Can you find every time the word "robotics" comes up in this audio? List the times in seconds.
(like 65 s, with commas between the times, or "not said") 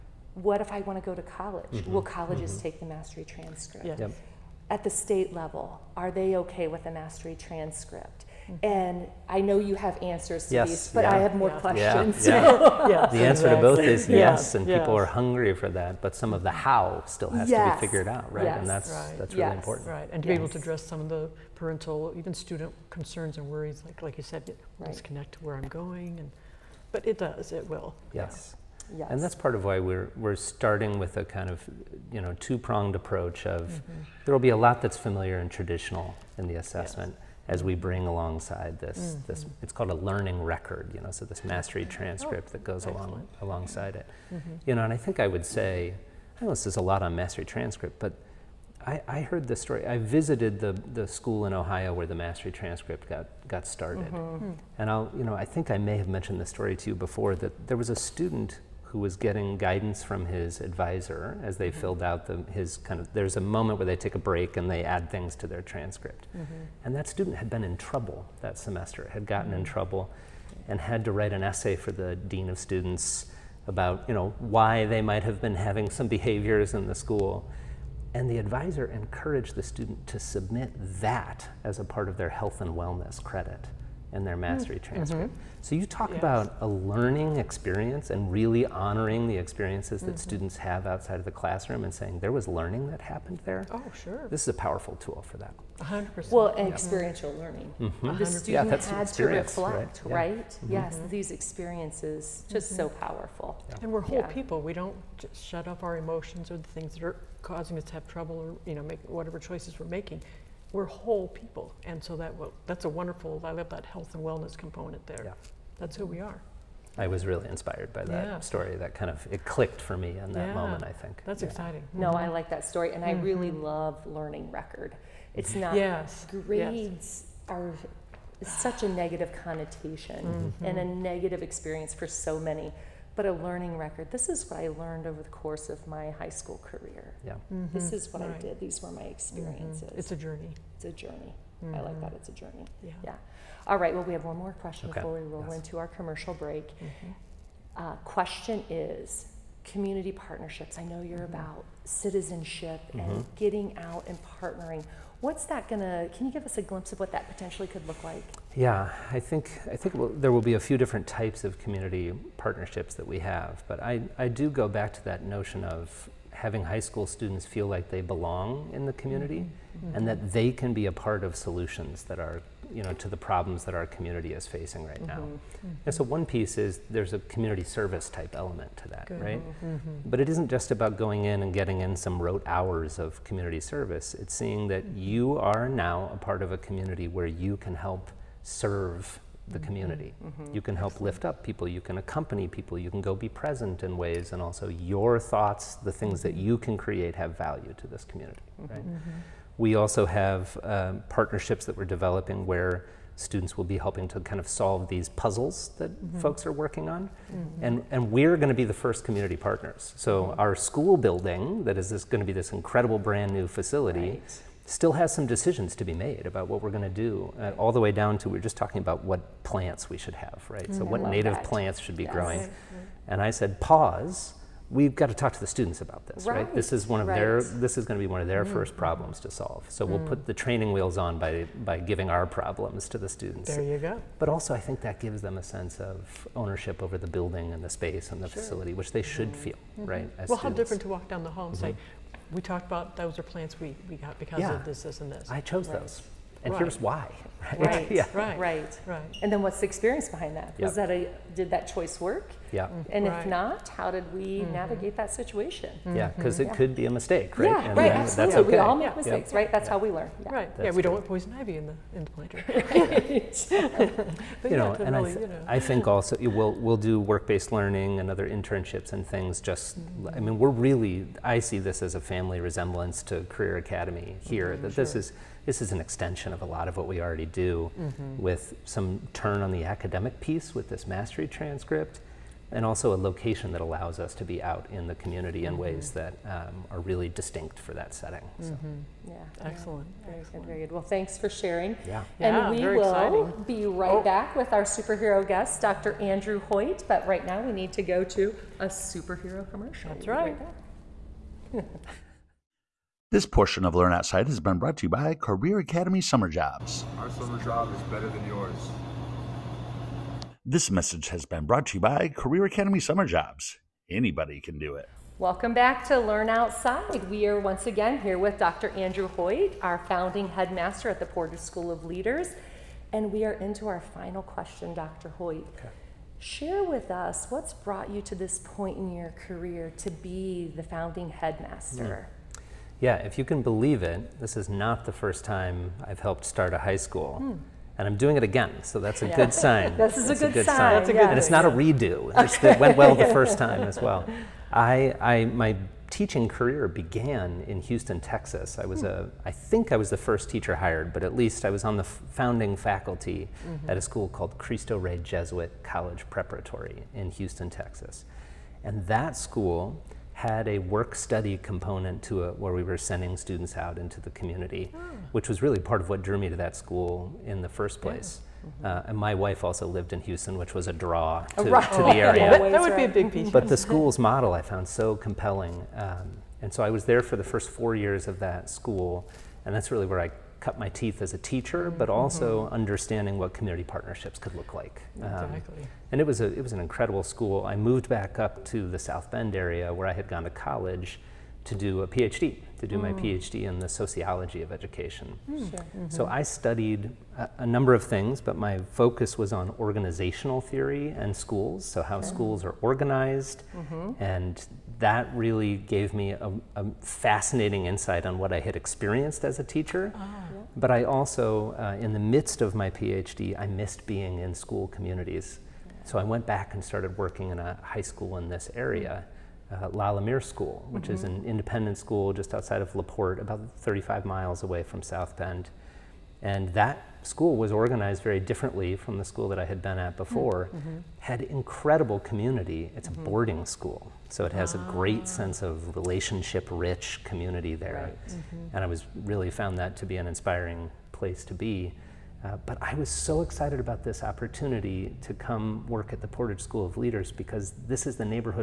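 not said.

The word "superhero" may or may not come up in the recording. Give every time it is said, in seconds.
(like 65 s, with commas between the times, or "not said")
294 s, 298 s.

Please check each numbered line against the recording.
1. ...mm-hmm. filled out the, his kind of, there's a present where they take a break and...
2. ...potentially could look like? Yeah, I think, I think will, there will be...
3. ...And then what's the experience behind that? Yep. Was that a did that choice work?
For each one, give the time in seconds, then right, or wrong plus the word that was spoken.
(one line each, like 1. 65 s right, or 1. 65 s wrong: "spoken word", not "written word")
1. 61 s wrong: "moment", not "present"
2. 157 s right
3. 249 s right.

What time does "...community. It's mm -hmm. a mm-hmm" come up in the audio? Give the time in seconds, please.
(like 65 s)
431 s.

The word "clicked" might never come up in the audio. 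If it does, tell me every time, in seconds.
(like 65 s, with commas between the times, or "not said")
119 s.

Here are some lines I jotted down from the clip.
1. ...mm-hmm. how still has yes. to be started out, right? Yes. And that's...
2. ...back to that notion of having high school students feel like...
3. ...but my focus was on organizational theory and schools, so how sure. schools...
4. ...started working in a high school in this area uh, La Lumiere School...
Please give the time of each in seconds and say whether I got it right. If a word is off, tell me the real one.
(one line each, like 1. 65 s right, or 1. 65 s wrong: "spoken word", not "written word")
1. 16 s wrong: "figured", not "started"
2. 164 s right
3. 398 s right
4. 416 s right.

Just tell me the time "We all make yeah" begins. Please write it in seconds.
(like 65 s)
258 s.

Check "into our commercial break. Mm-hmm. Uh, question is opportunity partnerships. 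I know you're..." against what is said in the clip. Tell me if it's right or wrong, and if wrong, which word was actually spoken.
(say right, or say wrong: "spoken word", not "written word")
wrong: "community", not "opportunity".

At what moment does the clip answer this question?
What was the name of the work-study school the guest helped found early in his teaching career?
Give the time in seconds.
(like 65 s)
354 s.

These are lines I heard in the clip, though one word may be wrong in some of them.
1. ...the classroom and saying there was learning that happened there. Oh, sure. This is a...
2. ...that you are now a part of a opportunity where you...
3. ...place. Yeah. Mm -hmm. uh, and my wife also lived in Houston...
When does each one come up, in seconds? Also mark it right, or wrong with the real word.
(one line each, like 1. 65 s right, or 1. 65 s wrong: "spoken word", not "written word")
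1. 91 s right
2. 184 s wrong: "community", not "opportunity"
3. 367 s right.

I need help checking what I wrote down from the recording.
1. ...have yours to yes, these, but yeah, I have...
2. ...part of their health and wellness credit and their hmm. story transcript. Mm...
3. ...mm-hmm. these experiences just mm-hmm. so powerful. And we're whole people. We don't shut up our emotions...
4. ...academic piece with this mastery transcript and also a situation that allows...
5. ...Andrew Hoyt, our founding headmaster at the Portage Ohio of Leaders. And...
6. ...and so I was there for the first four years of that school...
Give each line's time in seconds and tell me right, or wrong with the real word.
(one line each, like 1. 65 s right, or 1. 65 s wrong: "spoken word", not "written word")
1. 9 s wrong: "answers", not "yours"
2. 81 s wrong: "mastery", not "story"
3. 100 s right
4. 279 s wrong: "location", not "situation"
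5. 318 s wrong: "School", not "Ohio"
6. 376 s right.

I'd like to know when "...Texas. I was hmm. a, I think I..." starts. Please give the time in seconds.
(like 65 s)
348 s.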